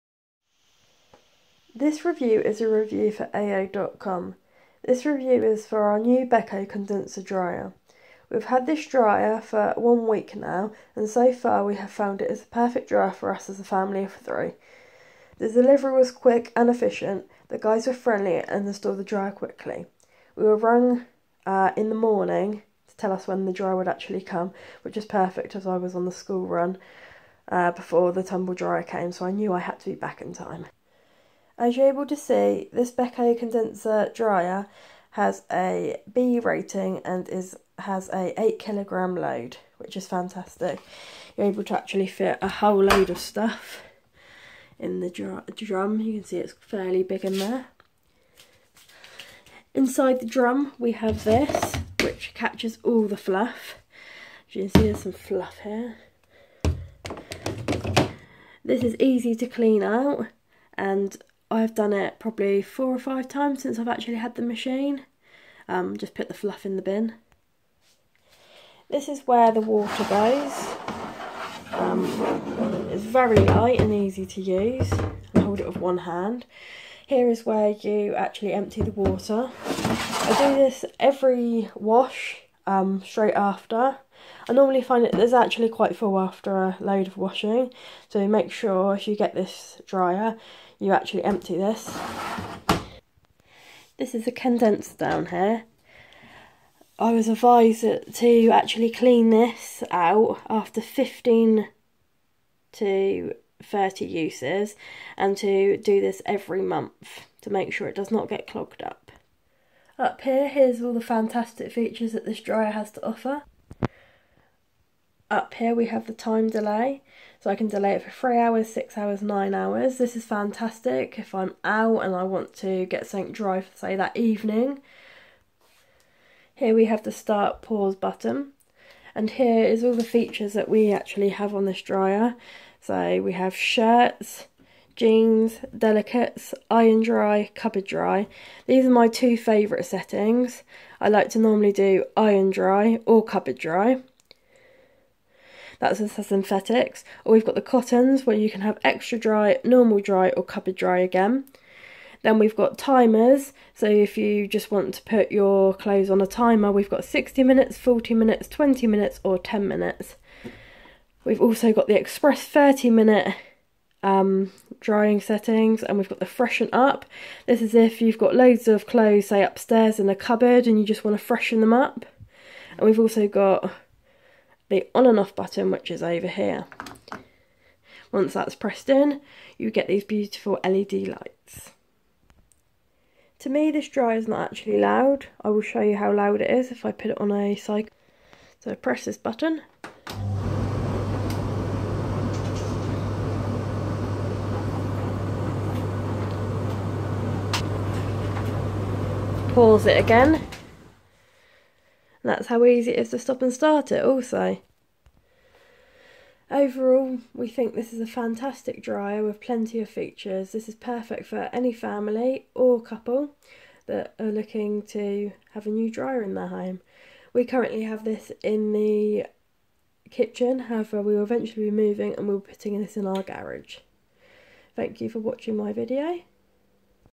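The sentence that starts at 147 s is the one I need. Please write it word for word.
Or we've got the cottons where you can have extra dry, normal dry or cupboard dry again.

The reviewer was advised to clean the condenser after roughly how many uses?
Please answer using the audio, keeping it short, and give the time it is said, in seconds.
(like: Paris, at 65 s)
15 to 30, at 100 s.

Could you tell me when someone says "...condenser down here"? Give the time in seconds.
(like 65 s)
94 s.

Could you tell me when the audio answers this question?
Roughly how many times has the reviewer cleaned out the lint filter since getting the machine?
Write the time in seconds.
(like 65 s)
62 s.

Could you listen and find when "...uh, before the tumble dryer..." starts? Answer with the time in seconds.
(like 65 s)
27 s.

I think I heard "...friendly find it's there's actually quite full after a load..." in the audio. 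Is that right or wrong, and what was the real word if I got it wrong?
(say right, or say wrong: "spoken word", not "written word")
wrong: "normally", not "friendly".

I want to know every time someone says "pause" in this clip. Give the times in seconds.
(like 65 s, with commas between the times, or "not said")
127 s, 199 s.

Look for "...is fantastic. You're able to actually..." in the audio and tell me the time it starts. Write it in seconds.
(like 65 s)
39 s.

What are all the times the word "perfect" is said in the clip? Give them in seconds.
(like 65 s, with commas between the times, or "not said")
12 s, 25 s, 210 s.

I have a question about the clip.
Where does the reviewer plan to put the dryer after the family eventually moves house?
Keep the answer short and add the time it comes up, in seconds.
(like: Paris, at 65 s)
Garage, at 223 s.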